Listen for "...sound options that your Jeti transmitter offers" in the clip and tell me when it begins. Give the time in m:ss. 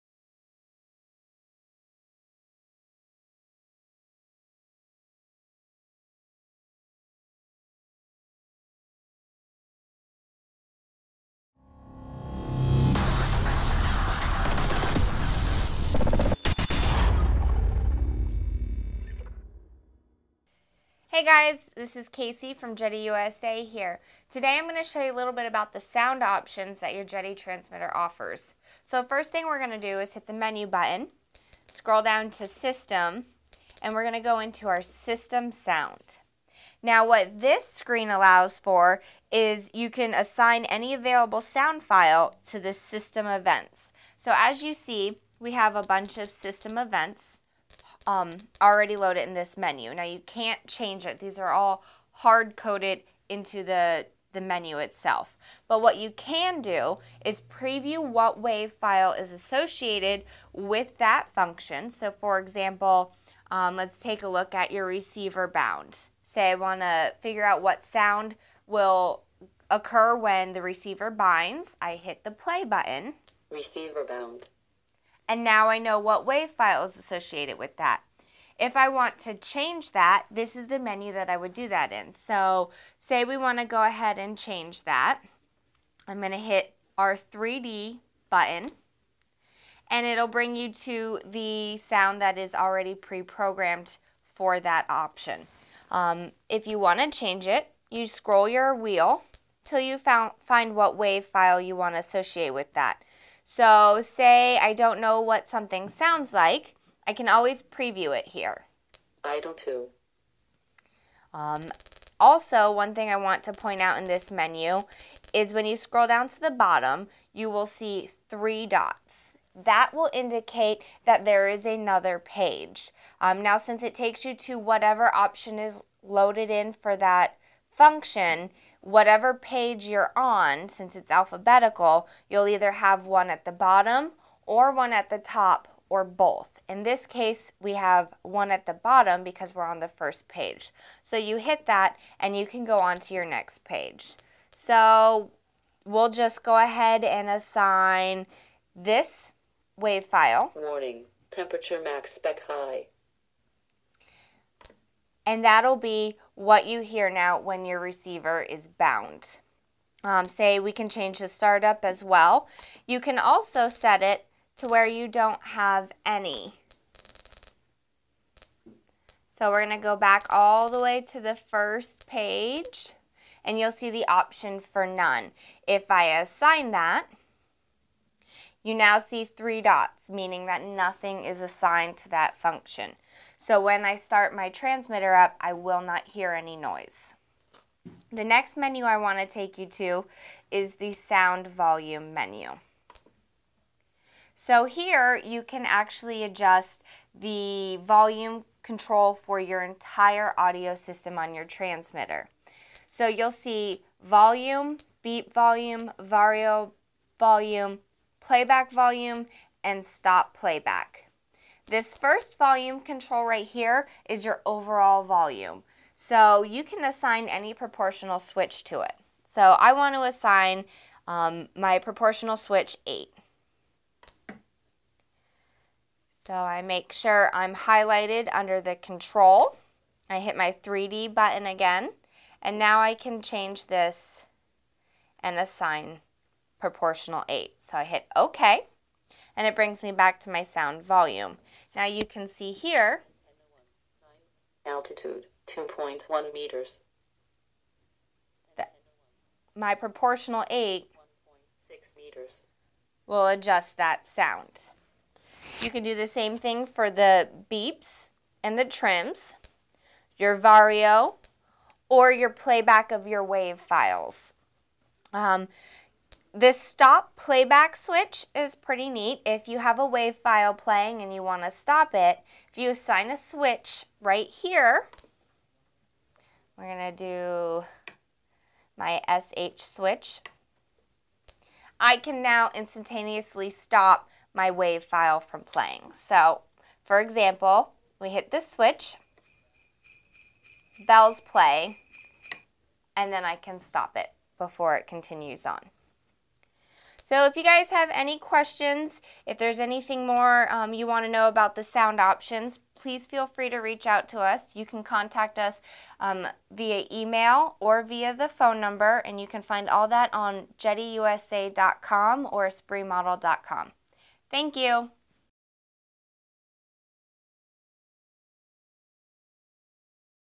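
0:25.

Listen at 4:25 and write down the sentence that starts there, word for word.
Um, this stop playback switch is pretty neat.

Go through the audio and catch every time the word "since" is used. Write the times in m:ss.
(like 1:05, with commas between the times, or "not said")
2:03, 2:10.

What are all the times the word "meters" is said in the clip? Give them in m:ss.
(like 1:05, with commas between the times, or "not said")
4:06, 4:11.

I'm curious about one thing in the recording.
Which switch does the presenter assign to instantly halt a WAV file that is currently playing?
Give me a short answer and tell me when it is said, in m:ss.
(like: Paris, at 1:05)
SH switch, at 4:39.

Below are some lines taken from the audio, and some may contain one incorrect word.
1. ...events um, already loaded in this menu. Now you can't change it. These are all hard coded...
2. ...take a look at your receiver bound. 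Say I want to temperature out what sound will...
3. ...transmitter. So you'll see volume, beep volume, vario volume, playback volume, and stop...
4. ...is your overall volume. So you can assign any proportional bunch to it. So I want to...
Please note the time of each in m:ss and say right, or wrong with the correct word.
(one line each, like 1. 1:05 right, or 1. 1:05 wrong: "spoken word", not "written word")
1. 0:46 right
2. 1:03 wrong: "figure", not "temperature"
3. 3:21 right
4. 3:34 wrong: "switch", not "bunch".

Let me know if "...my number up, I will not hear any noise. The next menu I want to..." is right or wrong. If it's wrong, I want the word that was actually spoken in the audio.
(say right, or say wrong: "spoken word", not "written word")
wrong: "transmitter", not "number".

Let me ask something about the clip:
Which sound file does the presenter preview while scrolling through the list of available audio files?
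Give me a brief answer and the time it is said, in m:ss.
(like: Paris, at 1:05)
Idle 2, at 1:49.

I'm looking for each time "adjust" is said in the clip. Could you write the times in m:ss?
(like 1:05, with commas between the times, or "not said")
3:16, 4:13.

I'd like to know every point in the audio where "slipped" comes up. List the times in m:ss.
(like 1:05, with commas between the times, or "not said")
not said.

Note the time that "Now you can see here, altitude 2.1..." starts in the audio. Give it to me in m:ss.
4:01.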